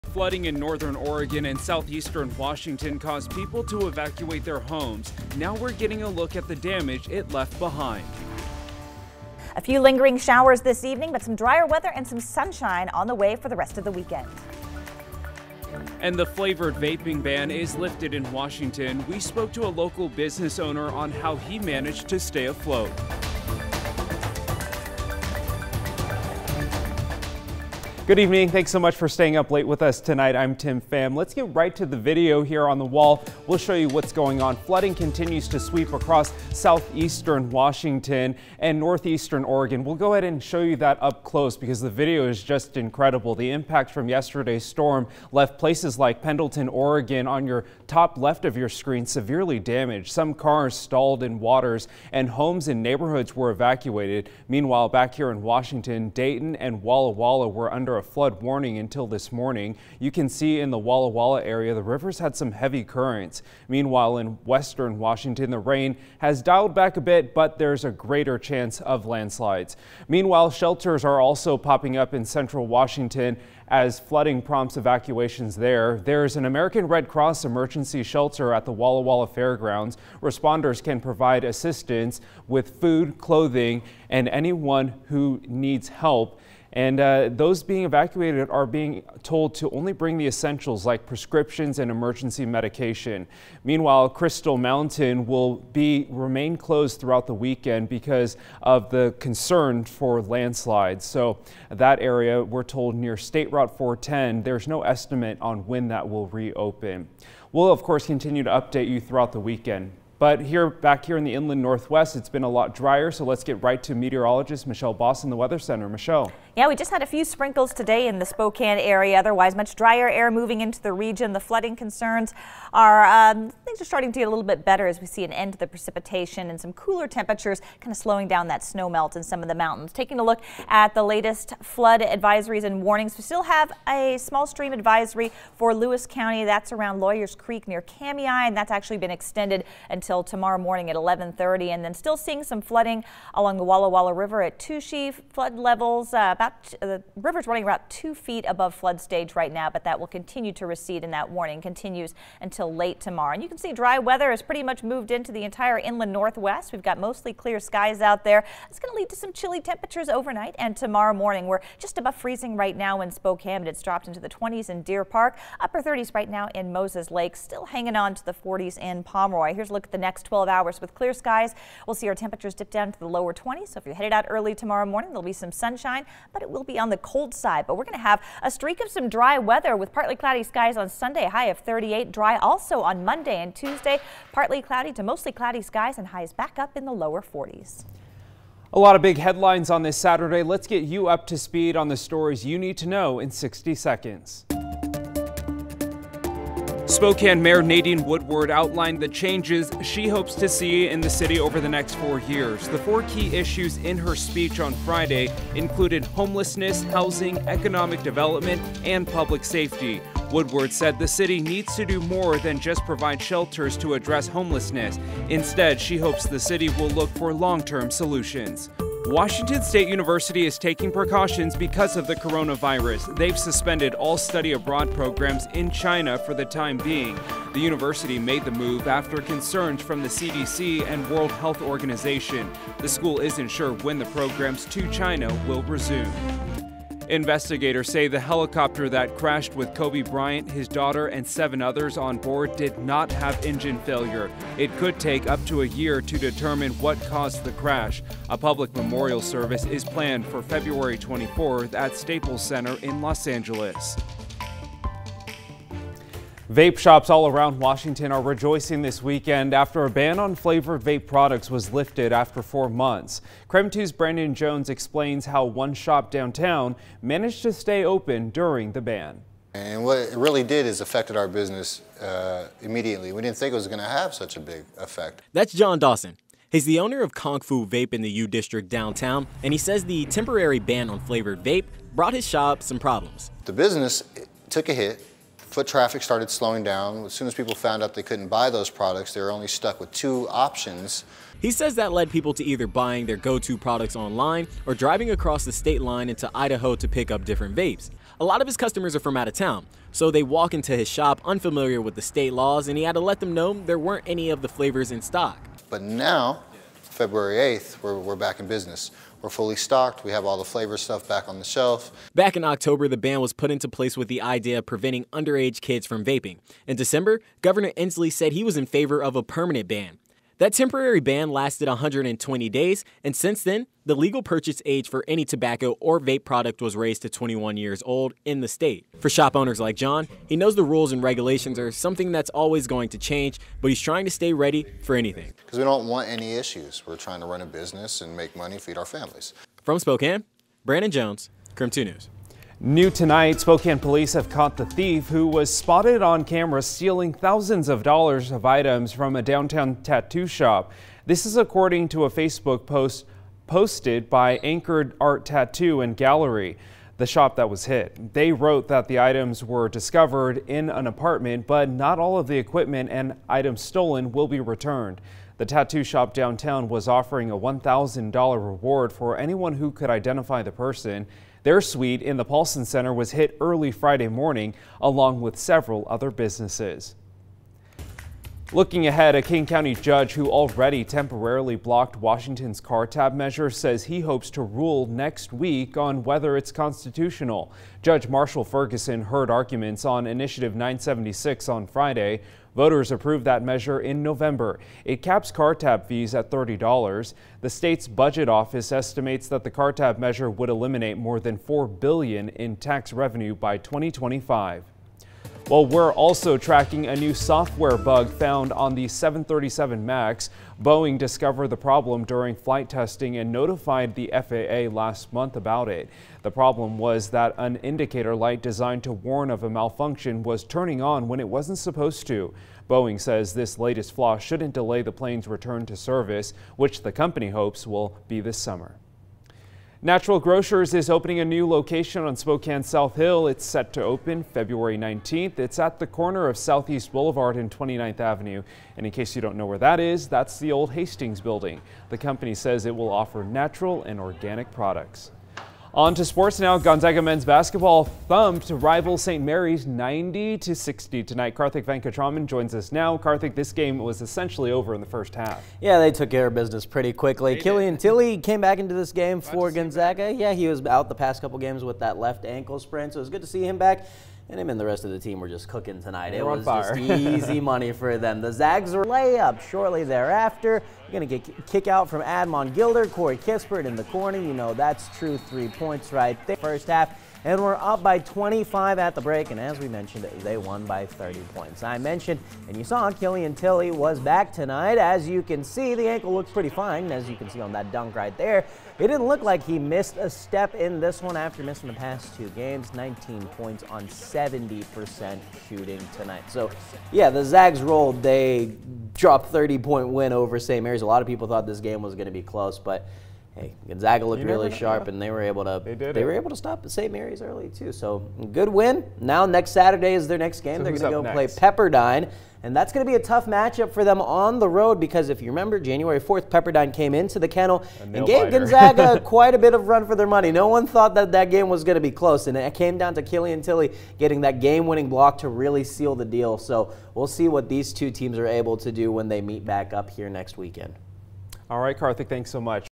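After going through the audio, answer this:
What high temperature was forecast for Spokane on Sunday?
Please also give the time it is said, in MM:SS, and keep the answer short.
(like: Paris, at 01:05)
38, at 03:01.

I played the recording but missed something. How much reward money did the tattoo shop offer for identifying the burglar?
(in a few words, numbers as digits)
$1,000.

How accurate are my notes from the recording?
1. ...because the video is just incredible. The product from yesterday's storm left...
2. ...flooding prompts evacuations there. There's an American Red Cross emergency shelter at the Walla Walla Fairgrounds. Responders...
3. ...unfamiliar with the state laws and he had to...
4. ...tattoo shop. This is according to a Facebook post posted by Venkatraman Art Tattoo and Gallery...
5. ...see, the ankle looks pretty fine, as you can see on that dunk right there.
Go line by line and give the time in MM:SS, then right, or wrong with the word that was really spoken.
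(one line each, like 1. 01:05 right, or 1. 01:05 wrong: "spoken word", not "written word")
1. 00:41 wrong: "impact", not "product"
2. 01:13 right
3. 05:01 right
4. 05:49 wrong: "Anchored", not "Venkatraman"
5. 08:05 right.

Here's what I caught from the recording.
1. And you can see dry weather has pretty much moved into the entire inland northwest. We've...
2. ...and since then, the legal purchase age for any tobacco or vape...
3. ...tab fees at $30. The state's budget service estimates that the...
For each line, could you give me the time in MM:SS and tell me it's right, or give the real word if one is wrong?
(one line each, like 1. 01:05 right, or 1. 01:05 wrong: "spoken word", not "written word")
1. 02:33 right
2. 05:23 right
3. 06:35 wrong: "office", not "service".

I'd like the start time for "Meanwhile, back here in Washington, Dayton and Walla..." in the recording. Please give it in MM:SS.
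00:54.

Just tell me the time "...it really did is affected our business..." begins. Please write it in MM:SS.
04:29.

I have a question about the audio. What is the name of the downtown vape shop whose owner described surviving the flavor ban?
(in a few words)
Kung Fu Vape.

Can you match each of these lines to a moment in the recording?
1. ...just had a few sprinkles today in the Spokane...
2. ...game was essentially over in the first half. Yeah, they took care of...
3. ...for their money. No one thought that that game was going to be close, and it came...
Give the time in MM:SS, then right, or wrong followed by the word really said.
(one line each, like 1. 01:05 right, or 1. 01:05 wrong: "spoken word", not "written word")
1. 01:56 right
2. 07:33 right
3. 08:39 right.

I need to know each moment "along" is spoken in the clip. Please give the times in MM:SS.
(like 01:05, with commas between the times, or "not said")
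02:23, 06:14.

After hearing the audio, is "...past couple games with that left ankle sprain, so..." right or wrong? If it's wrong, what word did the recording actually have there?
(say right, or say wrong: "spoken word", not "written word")
right.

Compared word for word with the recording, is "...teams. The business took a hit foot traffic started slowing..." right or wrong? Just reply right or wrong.
wrong.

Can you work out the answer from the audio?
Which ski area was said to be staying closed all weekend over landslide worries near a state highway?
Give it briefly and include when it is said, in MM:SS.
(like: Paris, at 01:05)
Crystal Mountain, at 01:34.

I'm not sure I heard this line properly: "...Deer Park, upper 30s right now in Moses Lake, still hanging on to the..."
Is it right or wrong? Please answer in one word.
right.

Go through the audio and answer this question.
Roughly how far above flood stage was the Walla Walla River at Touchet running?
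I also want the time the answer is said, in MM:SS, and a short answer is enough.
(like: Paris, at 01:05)
2 feet, at 02:27.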